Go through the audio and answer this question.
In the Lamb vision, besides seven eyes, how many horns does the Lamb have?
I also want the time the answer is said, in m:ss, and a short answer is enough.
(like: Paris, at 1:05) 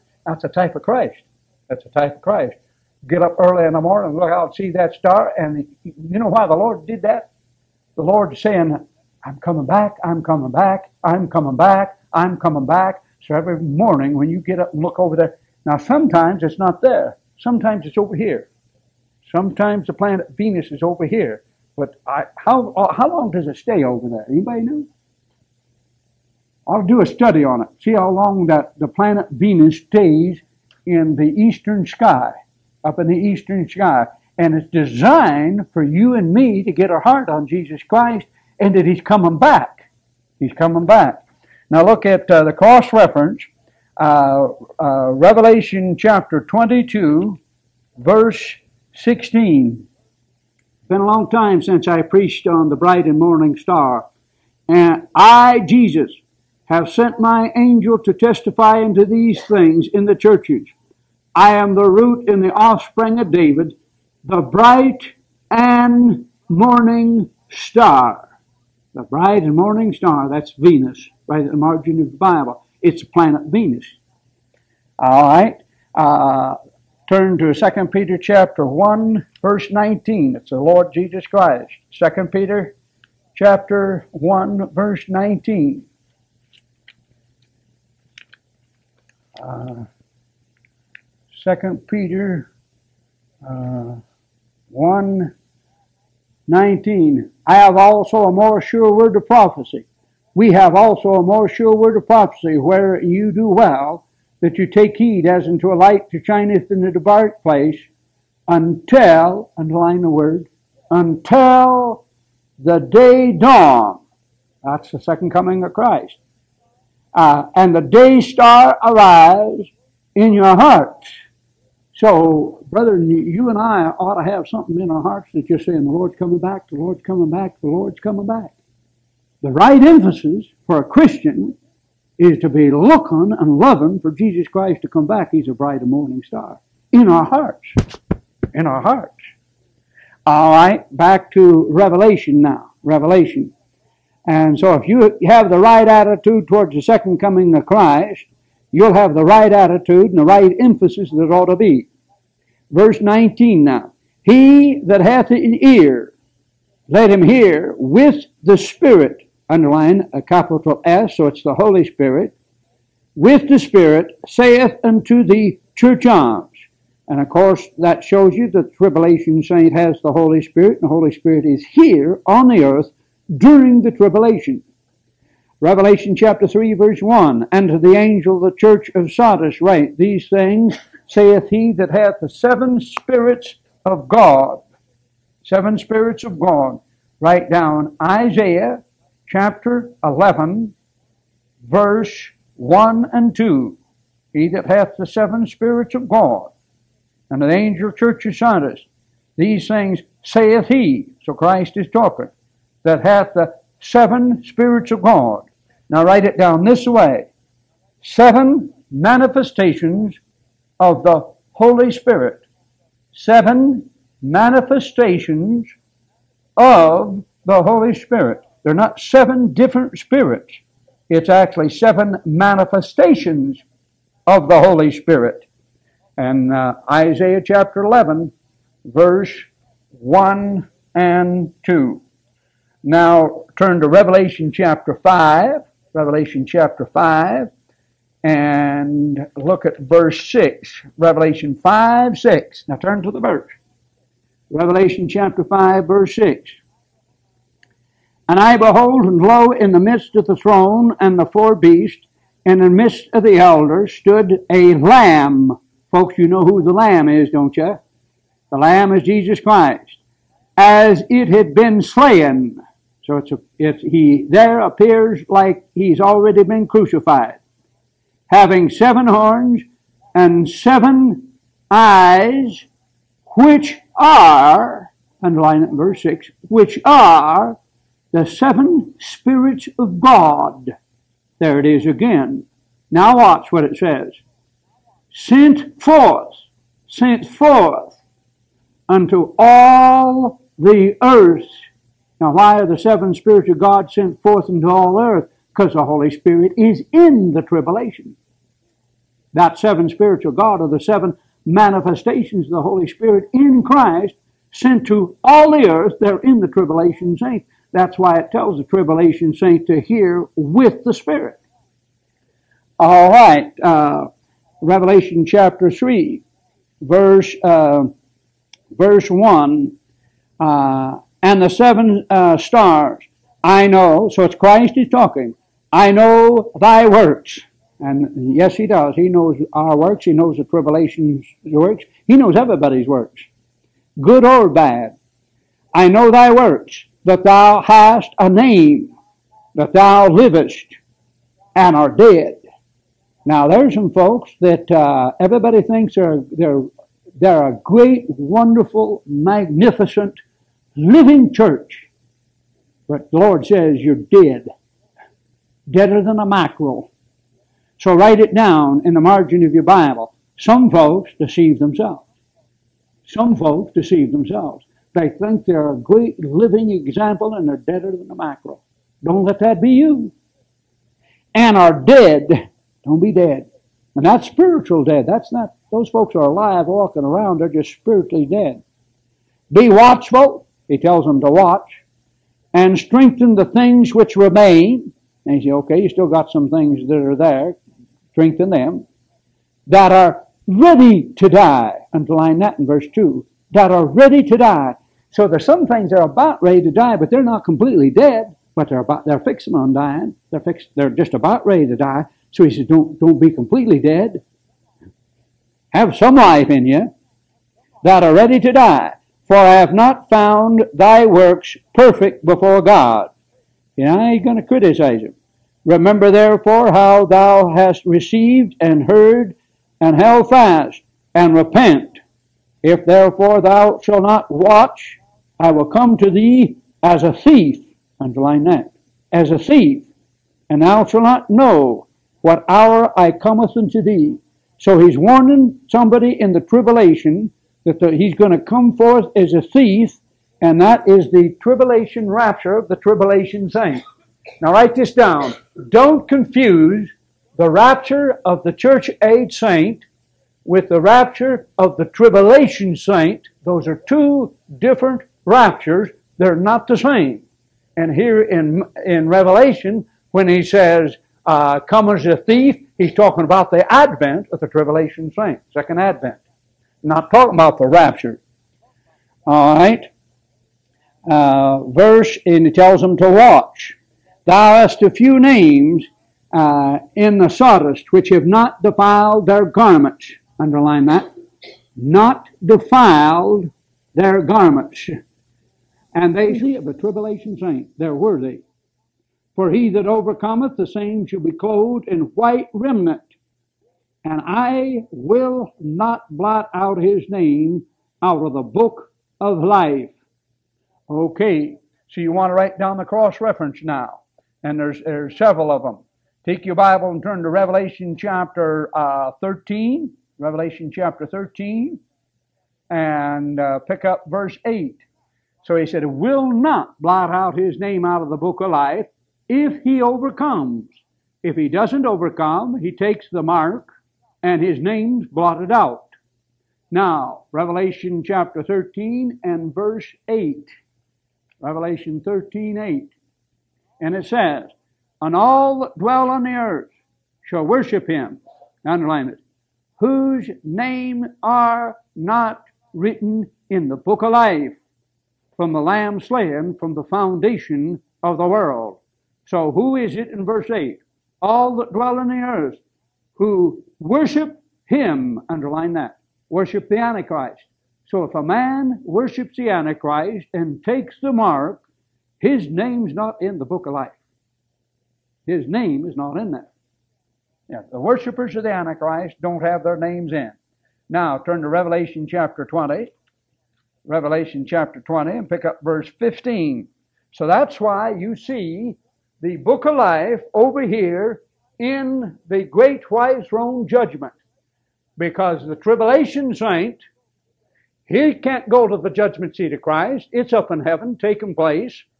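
7, at 4:28.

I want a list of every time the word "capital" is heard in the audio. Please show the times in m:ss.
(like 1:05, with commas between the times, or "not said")
2:40.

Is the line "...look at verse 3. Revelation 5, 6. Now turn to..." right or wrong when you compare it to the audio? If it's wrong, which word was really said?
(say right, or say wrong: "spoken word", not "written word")
wrong: "6", not "3".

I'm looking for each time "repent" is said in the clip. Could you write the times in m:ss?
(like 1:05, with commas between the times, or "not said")
7:01.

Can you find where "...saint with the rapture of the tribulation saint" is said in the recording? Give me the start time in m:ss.
7:29.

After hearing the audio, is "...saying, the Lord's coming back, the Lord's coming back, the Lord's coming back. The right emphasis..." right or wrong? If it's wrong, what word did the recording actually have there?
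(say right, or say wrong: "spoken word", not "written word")
right.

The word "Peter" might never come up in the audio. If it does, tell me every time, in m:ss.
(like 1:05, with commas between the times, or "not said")
1:17, 1:22, 1:31.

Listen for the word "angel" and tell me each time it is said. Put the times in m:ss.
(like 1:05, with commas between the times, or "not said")
0:57, 2:57, 3:17.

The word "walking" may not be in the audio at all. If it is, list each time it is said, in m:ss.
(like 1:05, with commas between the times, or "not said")
6:16.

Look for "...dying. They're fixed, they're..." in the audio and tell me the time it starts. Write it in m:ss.
6:39.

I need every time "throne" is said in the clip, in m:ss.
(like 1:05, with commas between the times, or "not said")
4:10, 9:43.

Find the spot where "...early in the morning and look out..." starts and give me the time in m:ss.
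0:03.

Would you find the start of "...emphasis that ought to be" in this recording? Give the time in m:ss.
2:30.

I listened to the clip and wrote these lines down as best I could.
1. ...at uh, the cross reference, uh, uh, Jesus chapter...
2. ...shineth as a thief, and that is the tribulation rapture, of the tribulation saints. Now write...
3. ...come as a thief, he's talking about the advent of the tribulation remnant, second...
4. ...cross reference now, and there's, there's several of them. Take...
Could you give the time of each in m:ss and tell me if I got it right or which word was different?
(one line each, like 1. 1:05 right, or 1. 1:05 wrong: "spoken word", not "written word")
1. 0:42 wrong: "Revelation", not "Jesus"
2. 7:18 wrong: "forth", not "shineth"
3. 7:41 wrong: "saint", not "remnant"
4. 8:22 right.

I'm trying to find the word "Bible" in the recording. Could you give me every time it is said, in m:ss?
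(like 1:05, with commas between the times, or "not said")
1:12, 5:59, 8:26.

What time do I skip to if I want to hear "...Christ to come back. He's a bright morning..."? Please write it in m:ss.
2:14.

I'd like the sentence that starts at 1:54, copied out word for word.
That's the second coming of Christ.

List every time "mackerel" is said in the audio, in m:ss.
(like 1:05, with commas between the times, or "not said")
5:56, 6:08.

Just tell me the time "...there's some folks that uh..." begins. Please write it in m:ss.
5:43.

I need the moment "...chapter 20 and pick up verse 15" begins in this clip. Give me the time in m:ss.
9:34.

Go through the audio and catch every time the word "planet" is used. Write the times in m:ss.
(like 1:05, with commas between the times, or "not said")
0:19, 0:28, 1:13.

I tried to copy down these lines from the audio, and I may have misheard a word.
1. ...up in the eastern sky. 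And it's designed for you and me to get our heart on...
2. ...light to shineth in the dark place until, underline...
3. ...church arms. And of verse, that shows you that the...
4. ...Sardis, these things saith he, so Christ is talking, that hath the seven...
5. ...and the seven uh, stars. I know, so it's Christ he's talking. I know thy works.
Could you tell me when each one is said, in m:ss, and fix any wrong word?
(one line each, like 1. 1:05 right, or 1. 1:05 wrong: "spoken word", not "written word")
1. 0:32 right
2. 1:45 right
3. 2:45 wrong: "course", not "verse"
4. 3:18 right
5. 5:21 right.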